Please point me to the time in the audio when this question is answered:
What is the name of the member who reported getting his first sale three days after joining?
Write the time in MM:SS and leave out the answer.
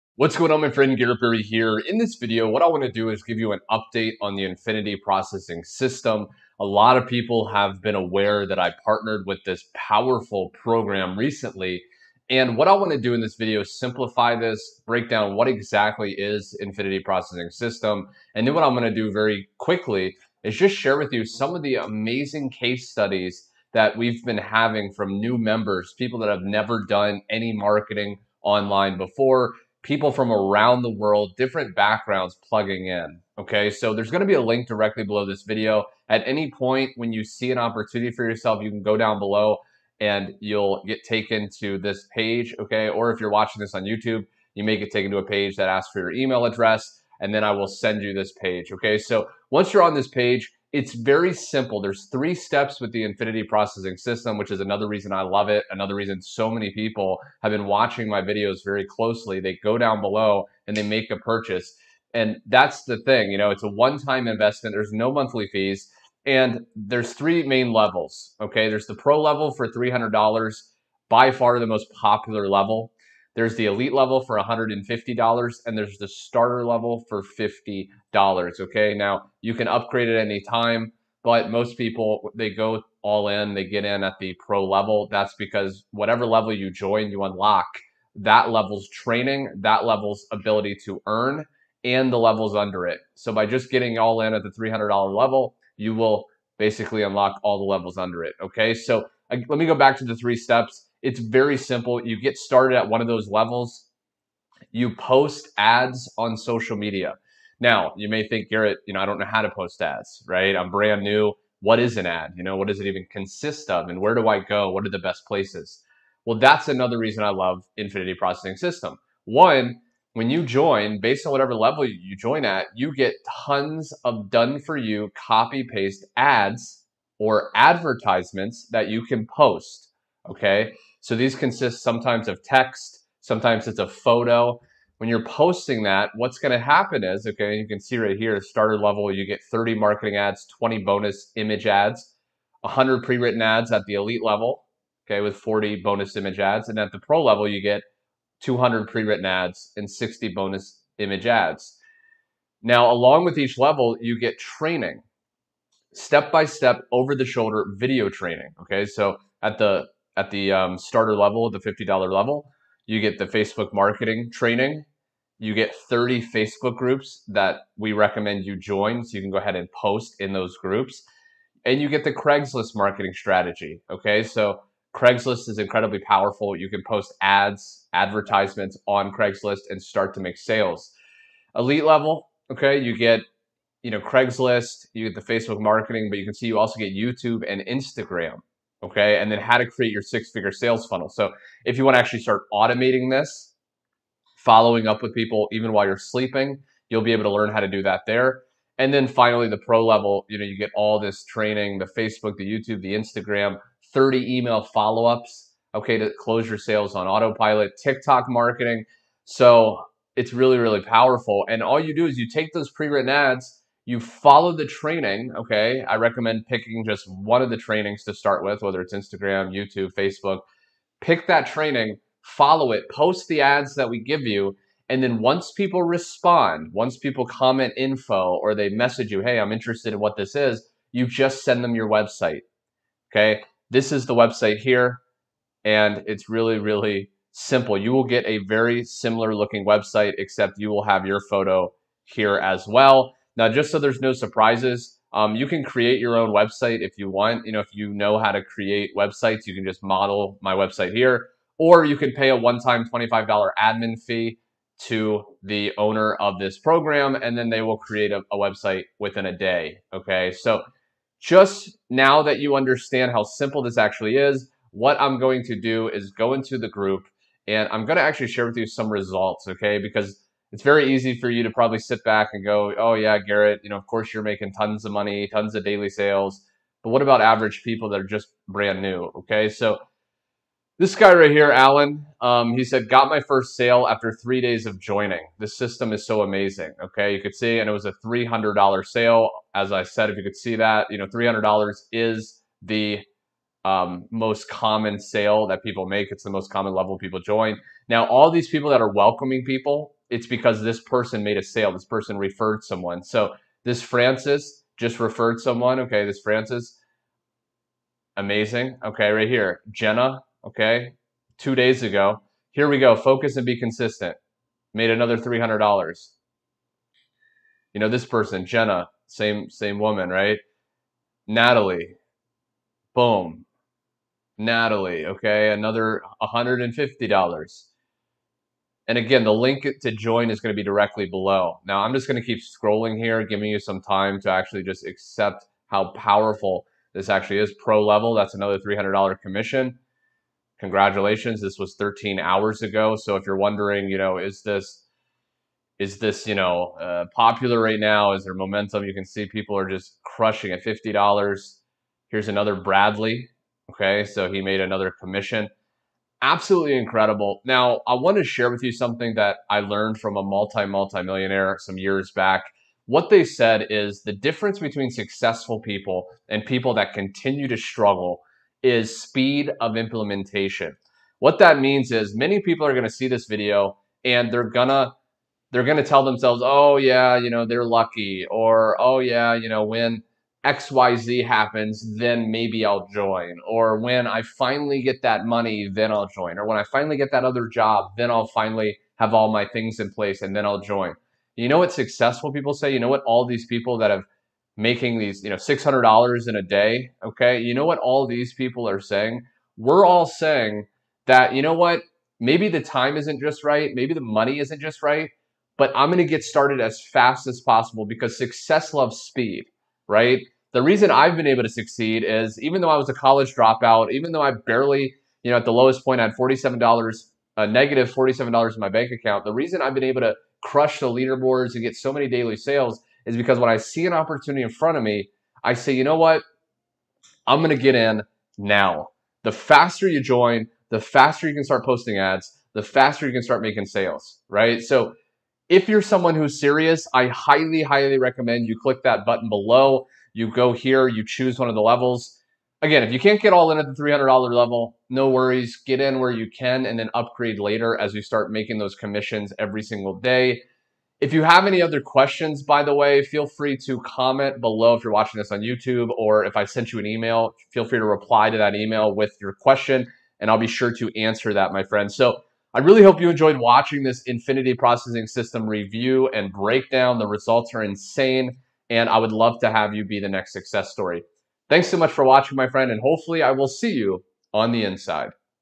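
04:41.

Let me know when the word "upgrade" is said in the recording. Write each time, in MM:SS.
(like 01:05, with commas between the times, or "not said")
01:19, 07:26.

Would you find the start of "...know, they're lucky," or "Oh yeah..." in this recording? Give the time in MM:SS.
06:17.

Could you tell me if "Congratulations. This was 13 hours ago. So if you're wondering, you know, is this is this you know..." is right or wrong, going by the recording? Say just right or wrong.
right.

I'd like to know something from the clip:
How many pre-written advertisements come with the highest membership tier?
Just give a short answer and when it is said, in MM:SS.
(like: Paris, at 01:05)
200, at 02:28.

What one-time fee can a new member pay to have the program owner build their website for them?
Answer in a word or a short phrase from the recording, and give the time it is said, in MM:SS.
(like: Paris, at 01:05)
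$25, at 04:12.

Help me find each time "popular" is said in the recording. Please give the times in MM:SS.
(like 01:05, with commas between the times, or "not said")
01:11, 05:47.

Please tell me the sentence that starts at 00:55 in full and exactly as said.
Another reason so many people have been watching my videos very closely.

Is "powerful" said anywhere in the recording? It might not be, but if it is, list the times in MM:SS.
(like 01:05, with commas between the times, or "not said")
00:09, 02:55, 03:30, 05:35.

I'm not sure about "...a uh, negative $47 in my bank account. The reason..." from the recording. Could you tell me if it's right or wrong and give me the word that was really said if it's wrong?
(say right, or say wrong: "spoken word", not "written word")
right.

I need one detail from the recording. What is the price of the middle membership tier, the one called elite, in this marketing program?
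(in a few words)
$150.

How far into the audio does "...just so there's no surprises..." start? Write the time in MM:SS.
04:03.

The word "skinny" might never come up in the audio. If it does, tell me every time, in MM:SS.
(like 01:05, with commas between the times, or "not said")
not said.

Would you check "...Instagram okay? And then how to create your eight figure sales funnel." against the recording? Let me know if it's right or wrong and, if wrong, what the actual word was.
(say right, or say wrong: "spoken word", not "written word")
wrong: "six", not "eight".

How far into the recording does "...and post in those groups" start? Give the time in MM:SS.
02:49.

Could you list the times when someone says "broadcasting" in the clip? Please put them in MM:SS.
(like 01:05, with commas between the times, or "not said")
not said.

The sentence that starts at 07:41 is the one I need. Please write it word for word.
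So I really hope you enjoyed watching this Infinity Processing System review and breakdown.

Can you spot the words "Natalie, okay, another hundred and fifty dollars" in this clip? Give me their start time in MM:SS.
05:24.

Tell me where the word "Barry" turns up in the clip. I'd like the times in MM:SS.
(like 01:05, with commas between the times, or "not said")
00:01.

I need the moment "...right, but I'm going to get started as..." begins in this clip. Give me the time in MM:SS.
06:44.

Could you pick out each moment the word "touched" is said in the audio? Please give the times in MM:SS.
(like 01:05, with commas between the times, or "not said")
not said.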